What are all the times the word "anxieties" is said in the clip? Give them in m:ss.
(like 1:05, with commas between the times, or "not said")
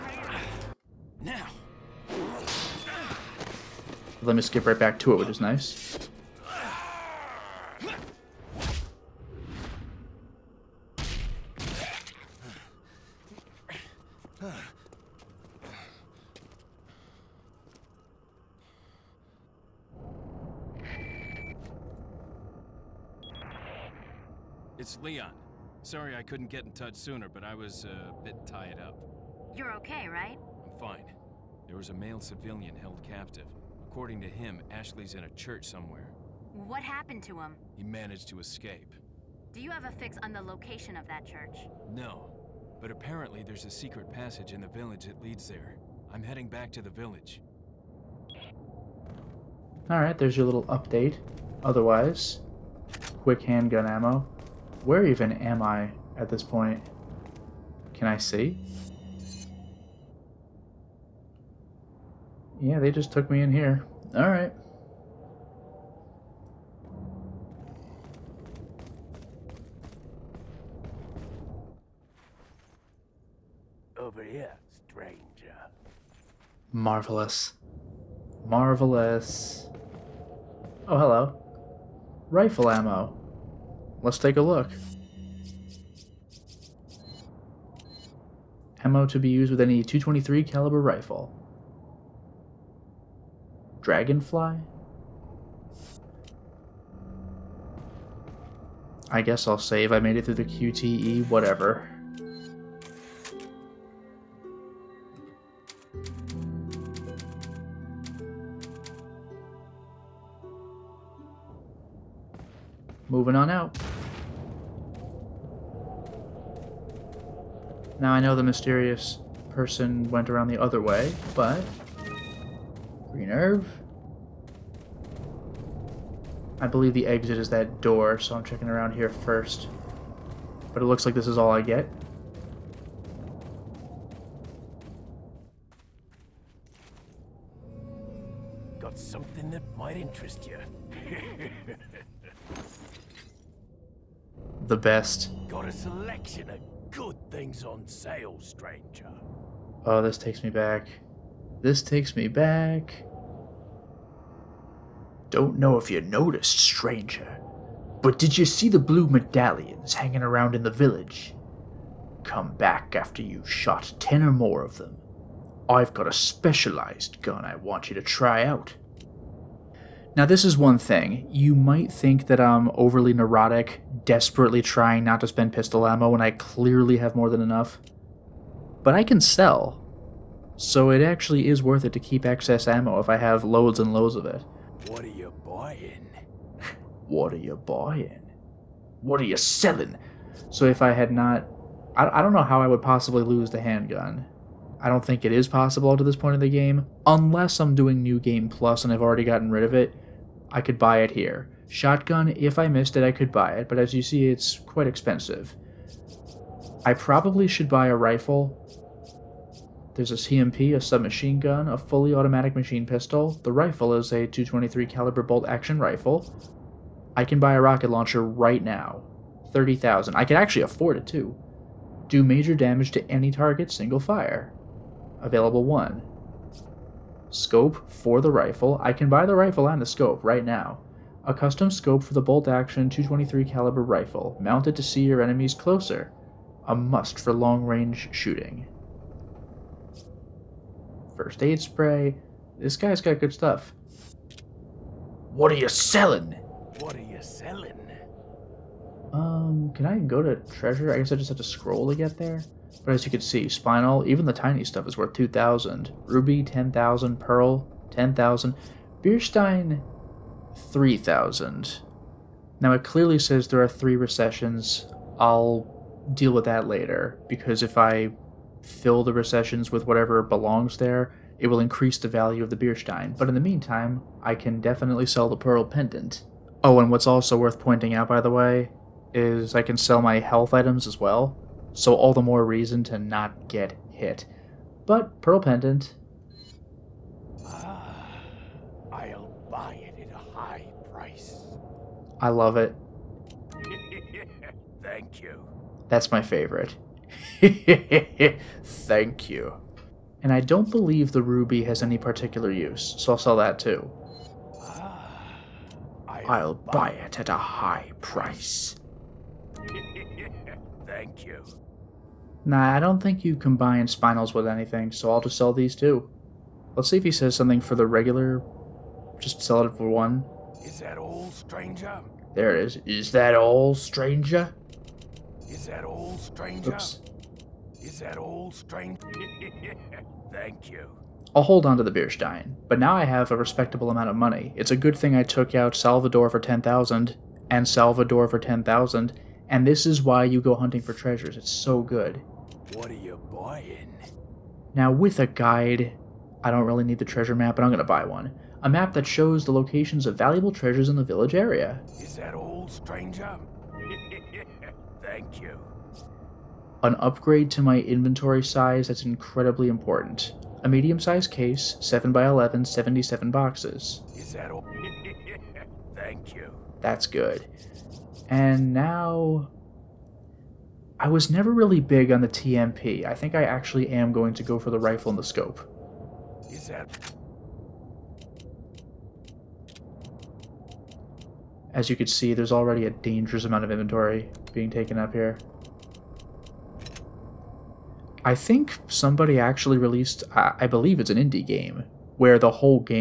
not said.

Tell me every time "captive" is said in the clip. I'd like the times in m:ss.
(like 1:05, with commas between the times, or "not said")
0:33.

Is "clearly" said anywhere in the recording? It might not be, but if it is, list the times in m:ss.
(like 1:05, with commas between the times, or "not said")
2:56, 4:22.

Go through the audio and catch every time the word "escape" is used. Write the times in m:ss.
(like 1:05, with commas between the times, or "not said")
0:38.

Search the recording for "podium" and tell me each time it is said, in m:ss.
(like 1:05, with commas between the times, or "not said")
not said.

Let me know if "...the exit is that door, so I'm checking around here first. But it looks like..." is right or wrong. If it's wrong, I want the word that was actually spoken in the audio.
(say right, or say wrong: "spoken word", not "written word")
right.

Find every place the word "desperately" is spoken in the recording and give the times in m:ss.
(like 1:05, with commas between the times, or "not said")
2:54.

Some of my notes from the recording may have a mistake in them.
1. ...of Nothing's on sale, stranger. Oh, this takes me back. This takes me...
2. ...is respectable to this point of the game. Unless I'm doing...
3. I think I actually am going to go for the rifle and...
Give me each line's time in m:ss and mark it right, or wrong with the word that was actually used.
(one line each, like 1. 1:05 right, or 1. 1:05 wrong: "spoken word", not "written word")
1. 2:26 right
2. 3:15 wrong: "possible", not "respectable"
3. 6:13 right.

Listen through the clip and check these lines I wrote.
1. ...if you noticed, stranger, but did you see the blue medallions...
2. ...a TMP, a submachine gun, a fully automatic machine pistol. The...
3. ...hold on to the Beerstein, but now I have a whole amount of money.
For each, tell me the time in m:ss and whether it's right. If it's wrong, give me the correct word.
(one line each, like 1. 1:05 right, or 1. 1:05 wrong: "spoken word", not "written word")
1. 2:35 right
2. 3:30 right
3. 5:31 wrong: "respectable", not "whole".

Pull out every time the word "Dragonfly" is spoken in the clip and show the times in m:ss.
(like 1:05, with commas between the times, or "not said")
1:33.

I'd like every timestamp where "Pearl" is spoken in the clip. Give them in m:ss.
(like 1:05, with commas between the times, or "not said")
4:17, 4:35, 4:45.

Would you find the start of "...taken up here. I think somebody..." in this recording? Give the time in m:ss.
6:24.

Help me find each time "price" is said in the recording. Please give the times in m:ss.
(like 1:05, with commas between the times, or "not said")
4:50, 5:08.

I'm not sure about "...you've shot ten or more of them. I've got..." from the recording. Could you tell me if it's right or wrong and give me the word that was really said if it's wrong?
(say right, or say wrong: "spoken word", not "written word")
right.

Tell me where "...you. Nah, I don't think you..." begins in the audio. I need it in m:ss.
5:11.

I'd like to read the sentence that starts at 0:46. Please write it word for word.
I'm heading back to the village.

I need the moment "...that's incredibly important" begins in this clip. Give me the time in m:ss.
5:58.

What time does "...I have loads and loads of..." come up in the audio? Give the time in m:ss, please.
3:03.